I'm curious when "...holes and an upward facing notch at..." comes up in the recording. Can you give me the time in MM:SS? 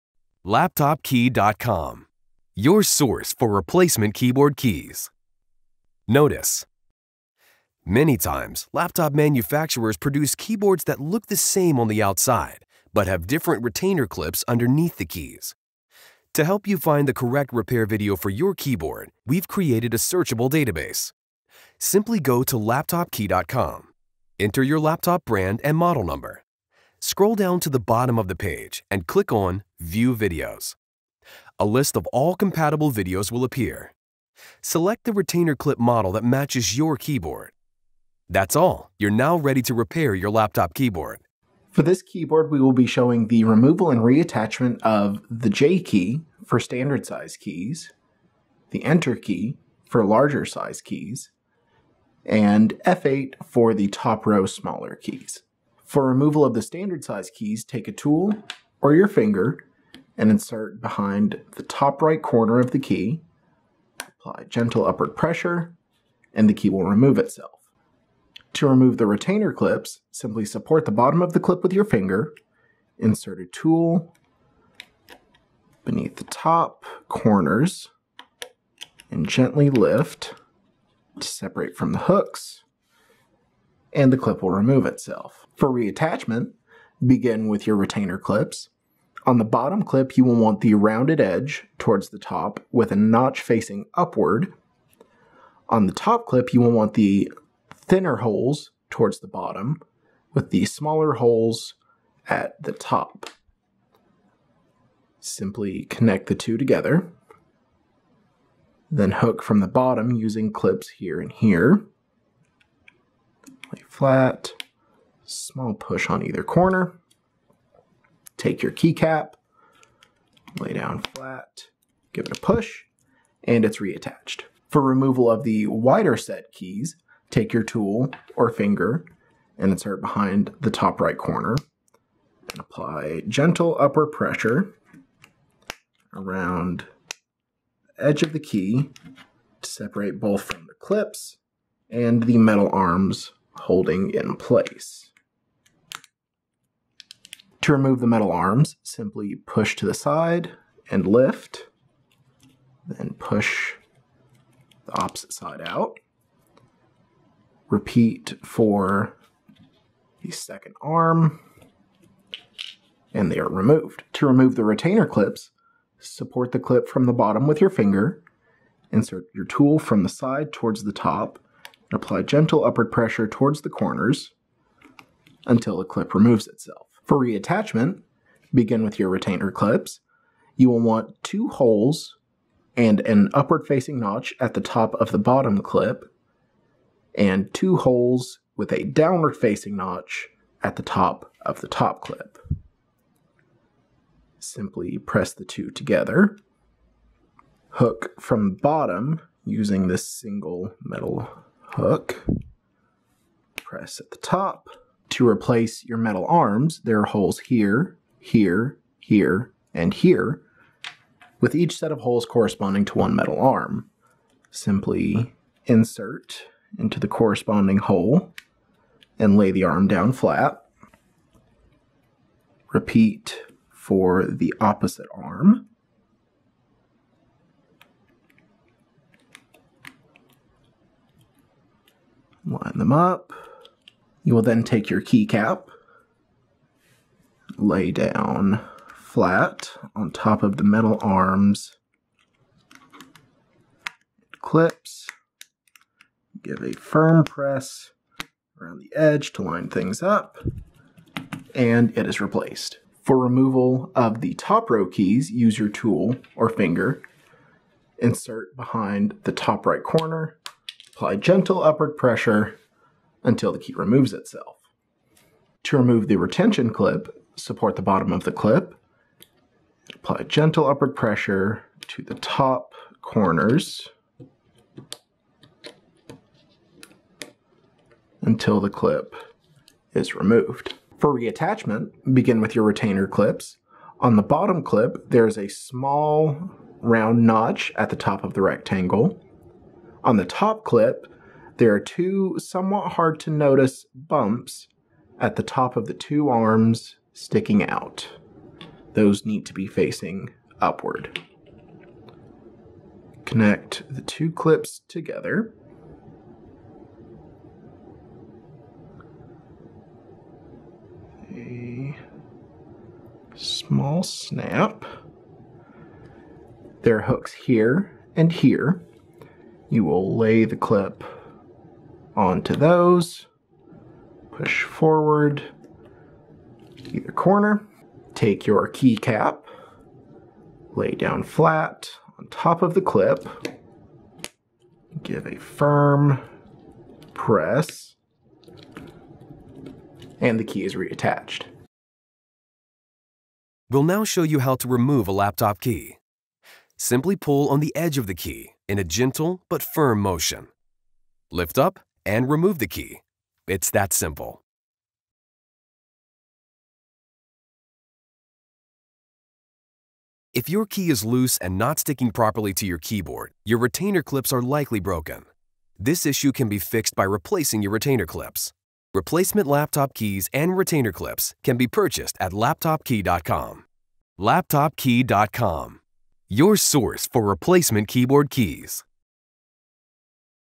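03:01.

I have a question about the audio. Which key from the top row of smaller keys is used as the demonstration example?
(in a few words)
F8.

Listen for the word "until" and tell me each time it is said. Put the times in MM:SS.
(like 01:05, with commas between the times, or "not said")
02:55, 04:23, 04:38.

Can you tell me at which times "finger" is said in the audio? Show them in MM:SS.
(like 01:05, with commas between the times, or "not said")
00:59, 01:11, 02:08, 02:47, 04:16.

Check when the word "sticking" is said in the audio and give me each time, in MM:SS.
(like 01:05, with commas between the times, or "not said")
04:57, 06:01.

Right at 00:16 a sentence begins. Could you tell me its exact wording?
To help you find the correct repair video for your keyboard, we've created a searchable database.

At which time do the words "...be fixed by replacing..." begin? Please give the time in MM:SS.
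06:06.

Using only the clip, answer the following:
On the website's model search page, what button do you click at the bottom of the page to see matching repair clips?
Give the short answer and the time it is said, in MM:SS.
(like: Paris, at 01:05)
View Videos, at 00:29.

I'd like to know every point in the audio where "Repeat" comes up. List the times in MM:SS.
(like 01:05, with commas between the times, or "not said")
02:37, 03:42.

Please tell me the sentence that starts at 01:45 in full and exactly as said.
Simply connect the two together, then hook from the bottom using clips here and here.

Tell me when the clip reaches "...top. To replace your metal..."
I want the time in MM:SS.
03:24.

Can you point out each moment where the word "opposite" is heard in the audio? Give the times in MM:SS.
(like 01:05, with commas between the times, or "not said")
02:35, 03:44.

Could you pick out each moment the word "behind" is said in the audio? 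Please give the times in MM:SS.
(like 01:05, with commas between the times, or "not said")
01:00, 02:10, 04:18.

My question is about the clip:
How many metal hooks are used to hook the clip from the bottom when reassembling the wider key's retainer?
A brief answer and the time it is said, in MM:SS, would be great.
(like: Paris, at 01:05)
1, at 03:20.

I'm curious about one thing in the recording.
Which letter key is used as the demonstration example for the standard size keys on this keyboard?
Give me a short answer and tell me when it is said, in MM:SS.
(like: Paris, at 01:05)
J, at 00:45.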